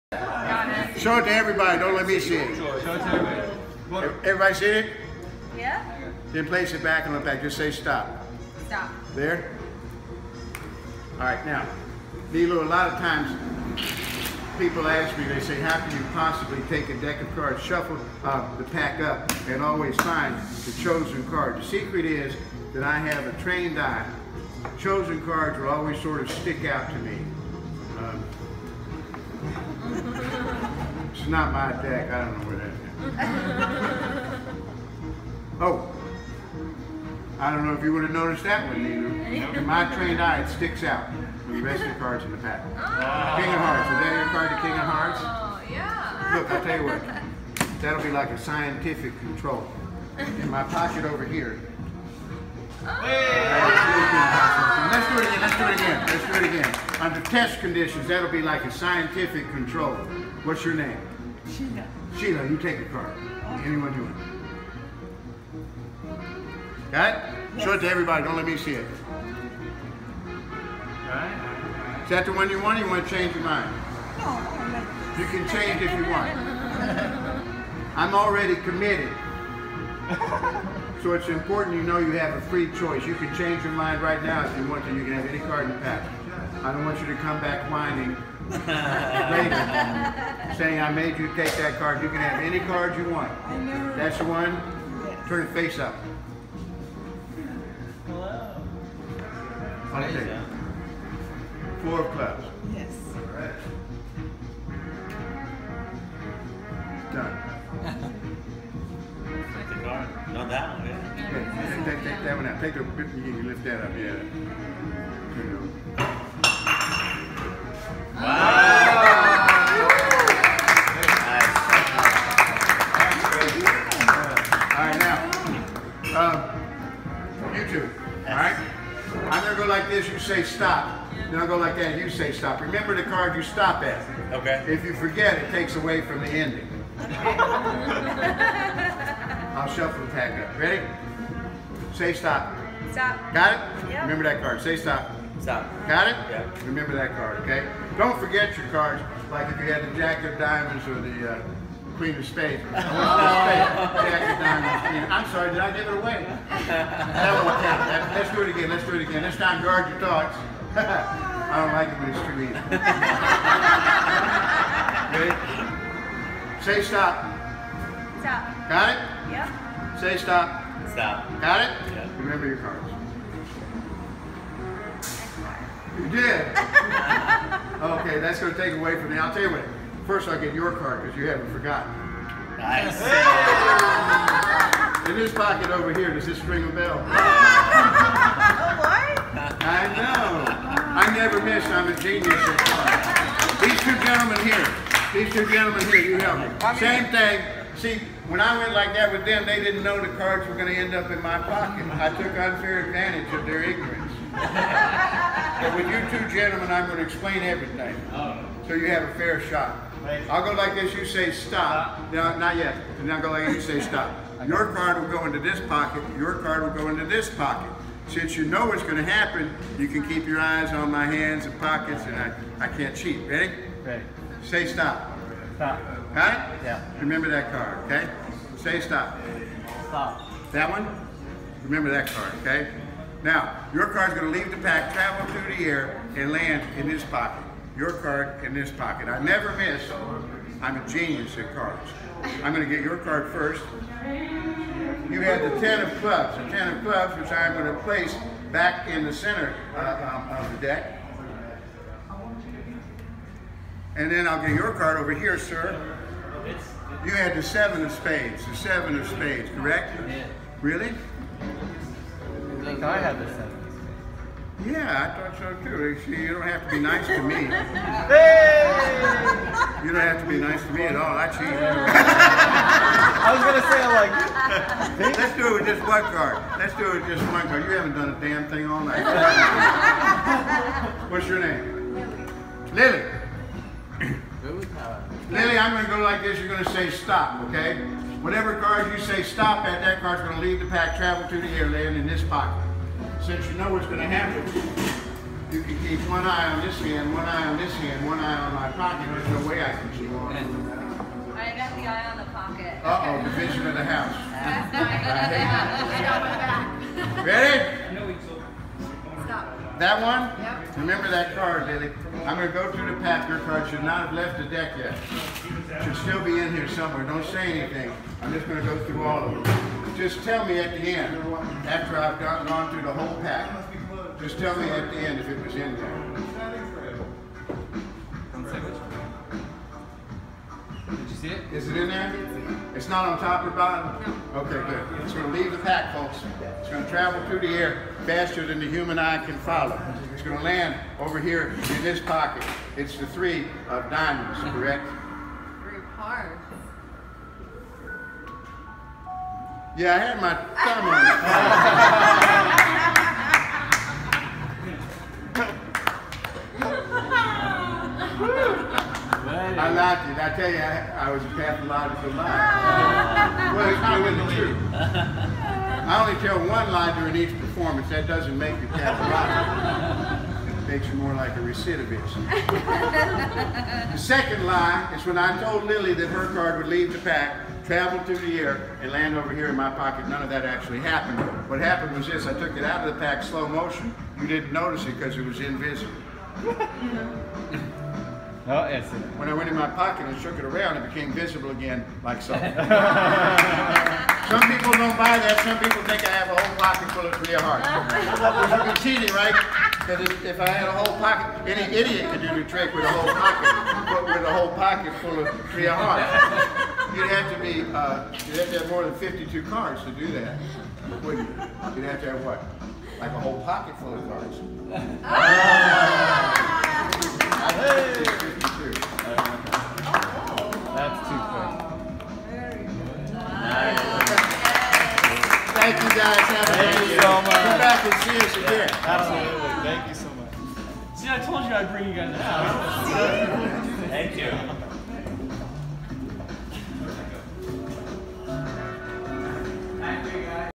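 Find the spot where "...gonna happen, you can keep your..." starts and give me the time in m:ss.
3:38.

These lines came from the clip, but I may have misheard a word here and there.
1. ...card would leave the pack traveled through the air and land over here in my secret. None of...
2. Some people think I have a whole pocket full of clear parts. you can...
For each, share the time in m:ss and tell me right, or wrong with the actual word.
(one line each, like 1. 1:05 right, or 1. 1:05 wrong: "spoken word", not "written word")
1. 6:16 wrong: "pocket", not "secret"
2. 6:35 wrong: "hearts", not "parts".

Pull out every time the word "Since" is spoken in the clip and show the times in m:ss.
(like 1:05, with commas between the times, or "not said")
3:38, 4:53.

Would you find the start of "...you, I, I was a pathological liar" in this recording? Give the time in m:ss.
6:00.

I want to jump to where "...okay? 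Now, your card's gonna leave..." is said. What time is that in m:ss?
3:52.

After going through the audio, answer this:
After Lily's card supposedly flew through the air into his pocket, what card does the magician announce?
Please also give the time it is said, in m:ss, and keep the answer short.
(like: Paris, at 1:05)
Three of diamonds, at 5:43.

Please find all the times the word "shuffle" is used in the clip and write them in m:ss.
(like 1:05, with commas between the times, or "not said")
0:17, 2:19.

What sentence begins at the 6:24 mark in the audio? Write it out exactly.
You didn't notice it because it was invisible.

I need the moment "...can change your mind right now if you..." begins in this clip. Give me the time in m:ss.
1:23.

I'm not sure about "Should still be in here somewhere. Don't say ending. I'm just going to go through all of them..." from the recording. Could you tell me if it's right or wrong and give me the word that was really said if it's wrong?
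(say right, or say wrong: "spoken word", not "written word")
wrong: "anything", not "ending".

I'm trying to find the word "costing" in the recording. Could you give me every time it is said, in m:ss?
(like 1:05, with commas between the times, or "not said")
not said.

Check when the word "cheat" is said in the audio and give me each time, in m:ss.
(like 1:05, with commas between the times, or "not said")
3:42, 4:31, 6:38.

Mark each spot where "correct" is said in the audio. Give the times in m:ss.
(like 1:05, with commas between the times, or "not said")
4:19, 5:44.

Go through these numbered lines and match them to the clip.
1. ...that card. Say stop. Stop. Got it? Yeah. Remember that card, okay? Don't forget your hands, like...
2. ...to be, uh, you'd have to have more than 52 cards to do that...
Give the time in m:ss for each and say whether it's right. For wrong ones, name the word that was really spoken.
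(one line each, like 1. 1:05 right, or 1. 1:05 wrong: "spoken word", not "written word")
1. 2:24 wrong: "cards", not "hands"
2. 6:47 right.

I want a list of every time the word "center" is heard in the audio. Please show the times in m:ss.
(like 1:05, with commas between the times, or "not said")
4:09.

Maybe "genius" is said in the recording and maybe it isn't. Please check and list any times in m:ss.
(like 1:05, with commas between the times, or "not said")
3:12, 4:00.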